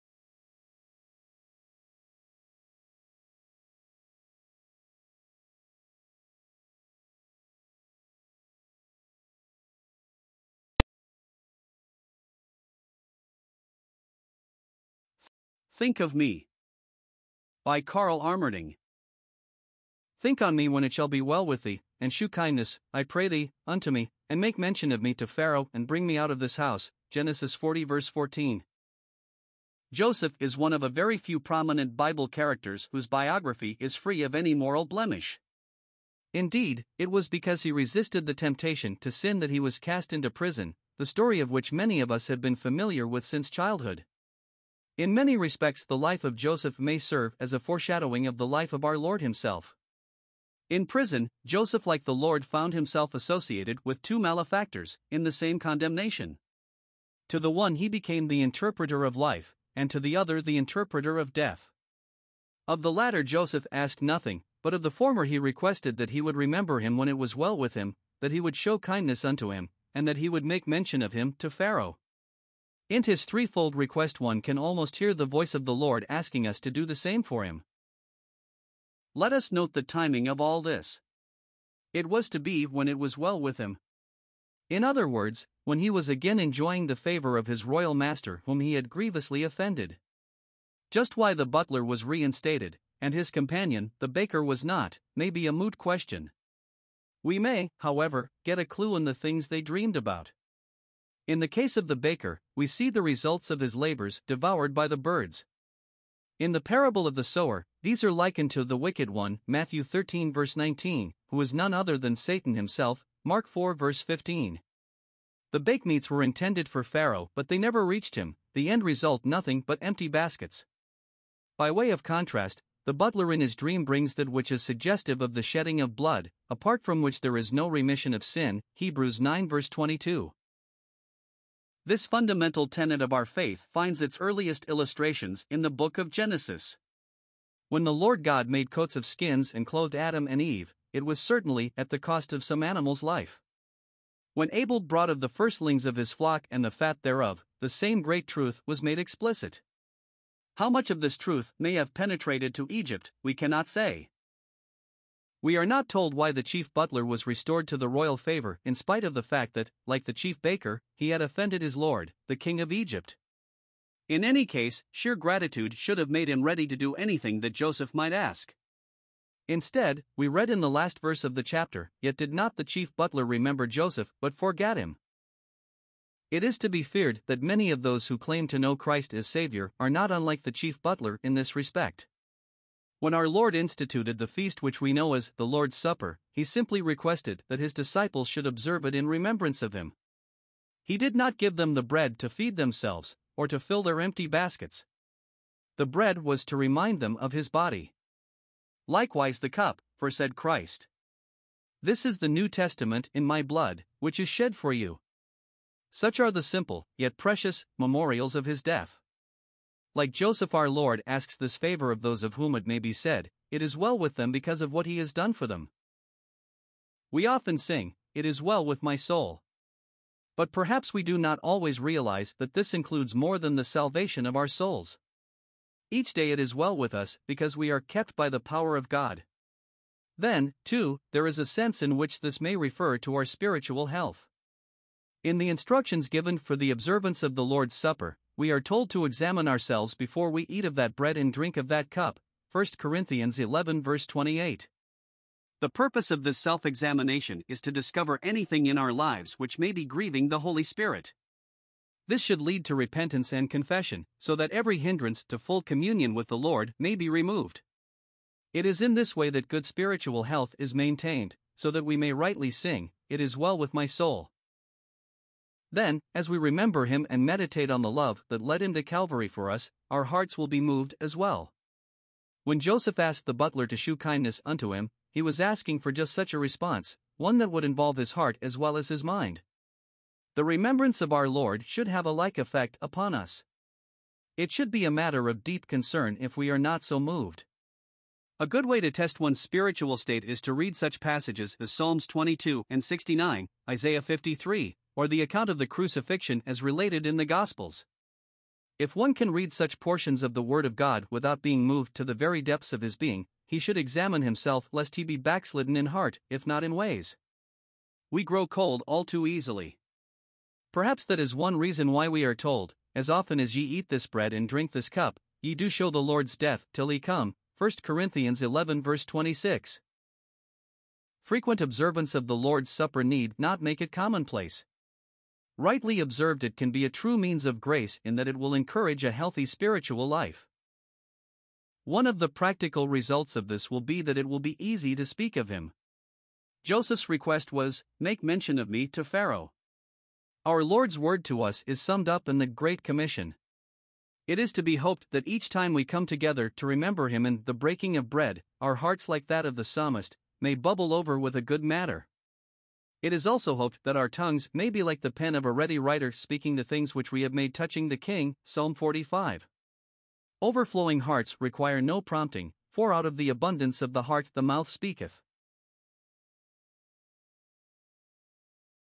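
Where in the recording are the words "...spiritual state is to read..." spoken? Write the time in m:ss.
4:49.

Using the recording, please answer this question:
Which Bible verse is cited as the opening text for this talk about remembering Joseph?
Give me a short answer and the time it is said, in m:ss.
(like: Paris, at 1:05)
Genesis 40:14, at 0:27.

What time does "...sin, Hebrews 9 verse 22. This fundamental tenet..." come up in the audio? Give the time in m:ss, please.
2:08.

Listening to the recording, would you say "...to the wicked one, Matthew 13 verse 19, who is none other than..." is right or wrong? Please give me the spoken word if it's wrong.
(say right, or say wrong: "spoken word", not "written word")
right.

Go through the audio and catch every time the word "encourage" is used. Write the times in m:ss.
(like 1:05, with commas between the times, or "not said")
5:28.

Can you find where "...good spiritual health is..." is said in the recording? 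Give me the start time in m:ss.
4:19.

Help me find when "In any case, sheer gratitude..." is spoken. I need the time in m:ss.
2:44.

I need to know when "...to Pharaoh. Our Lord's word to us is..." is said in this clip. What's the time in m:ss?
5:38.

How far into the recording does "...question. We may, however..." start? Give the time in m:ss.
1:35.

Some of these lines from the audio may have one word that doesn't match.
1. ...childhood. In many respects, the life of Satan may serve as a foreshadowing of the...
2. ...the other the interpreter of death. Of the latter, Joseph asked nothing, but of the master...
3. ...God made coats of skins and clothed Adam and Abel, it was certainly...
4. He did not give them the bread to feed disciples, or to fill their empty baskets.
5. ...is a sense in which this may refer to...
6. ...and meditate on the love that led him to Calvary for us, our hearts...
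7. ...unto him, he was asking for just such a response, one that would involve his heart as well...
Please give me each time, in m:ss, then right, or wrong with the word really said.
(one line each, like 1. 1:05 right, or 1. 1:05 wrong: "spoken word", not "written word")
1. 0:43 wrong: "Joseph", not "Satan"
2. 0:59 wrong: "former", not "master"
3. 2:18 wrong: "Eve", not "Abel"
4. 3:10 wrong: "themselves", not "disciples"
5. 3:51 right
6. 4:27 right
7. 4:34 right.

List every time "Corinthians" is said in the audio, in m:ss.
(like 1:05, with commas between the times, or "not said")
4:02, 5:17.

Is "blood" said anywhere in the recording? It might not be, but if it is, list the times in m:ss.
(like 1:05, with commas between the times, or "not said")
2:05, 3:23.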